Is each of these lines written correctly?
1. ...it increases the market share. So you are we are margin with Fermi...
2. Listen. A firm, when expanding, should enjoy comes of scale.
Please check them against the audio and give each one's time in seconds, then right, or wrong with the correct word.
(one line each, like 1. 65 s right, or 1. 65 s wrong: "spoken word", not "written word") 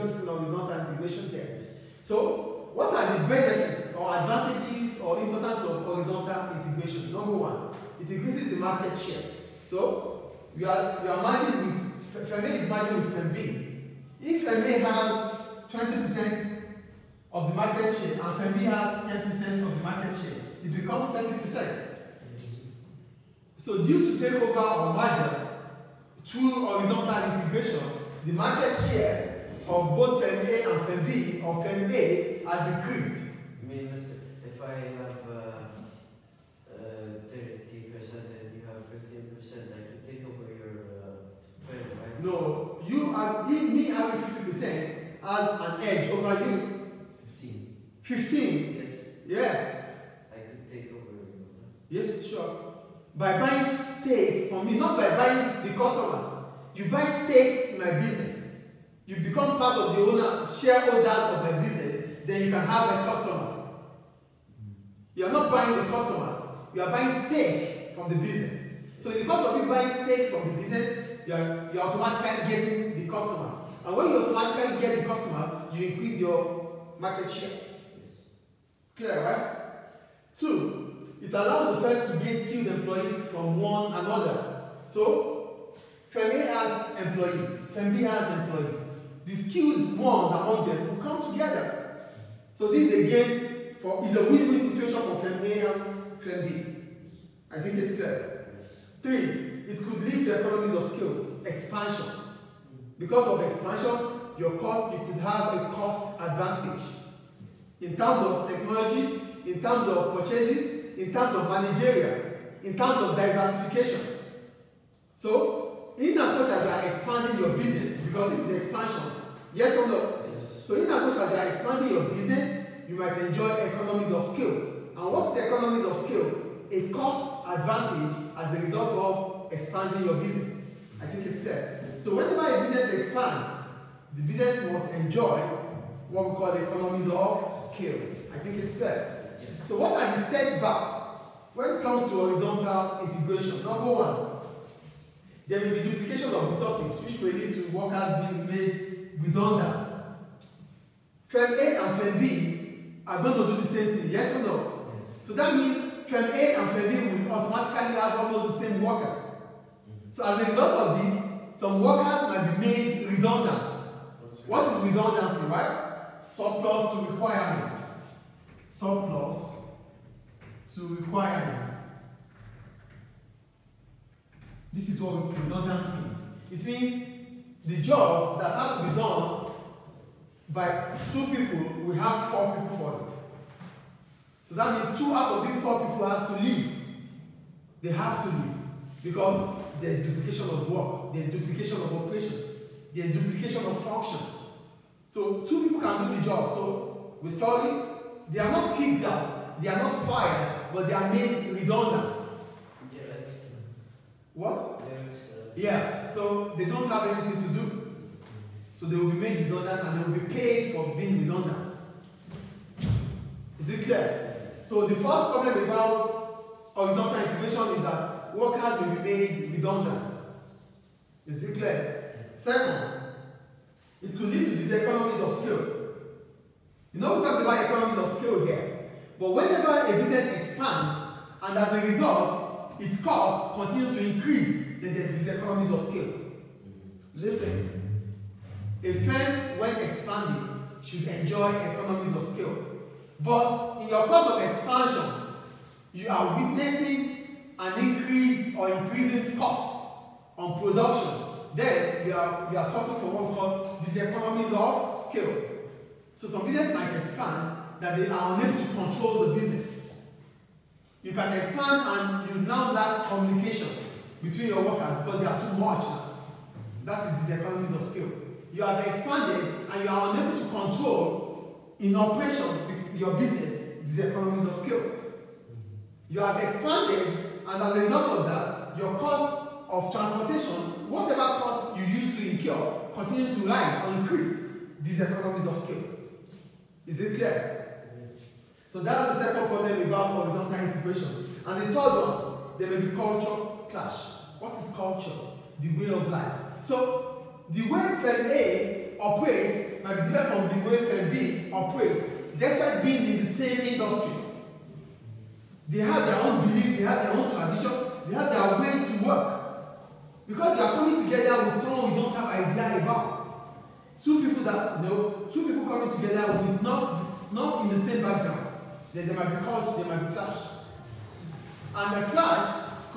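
1. 8 s right
2. 237 s wrong: "economies", not "comes".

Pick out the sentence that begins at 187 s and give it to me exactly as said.
They have to leave because there's duplication of work, there's duplication of operation, there's duplication of function.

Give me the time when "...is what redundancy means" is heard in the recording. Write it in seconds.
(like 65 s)
174 s.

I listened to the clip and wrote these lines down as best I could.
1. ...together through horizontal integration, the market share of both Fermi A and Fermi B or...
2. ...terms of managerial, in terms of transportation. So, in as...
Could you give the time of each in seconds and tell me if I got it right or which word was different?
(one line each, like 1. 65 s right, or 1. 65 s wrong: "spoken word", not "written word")
1. 24 s wrong: "merger", not "together"
2. 111 s wrong: "diversification", not "transportation".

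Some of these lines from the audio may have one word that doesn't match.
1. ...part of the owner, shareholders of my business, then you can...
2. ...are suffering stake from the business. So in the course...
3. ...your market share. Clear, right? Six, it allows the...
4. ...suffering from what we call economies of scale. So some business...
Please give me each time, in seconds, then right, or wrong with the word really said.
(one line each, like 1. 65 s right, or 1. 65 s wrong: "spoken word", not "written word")
1. 59 s right
2. 66 s wrong: "buying", not "suffering"
3. 76 s wrong: "Two", not "Six"
4. 252 s right.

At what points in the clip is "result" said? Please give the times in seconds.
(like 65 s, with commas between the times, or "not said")
128 s, 160 s, 231 s, 277 s.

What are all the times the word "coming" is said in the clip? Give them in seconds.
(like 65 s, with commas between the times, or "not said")
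310 s, 315 s.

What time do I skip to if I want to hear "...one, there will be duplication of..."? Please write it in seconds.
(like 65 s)
143 s.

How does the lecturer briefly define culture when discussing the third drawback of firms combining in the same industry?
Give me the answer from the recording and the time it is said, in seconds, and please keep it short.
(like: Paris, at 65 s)
The way of life, at 295 s.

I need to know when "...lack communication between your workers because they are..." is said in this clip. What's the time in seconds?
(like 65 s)
262 s.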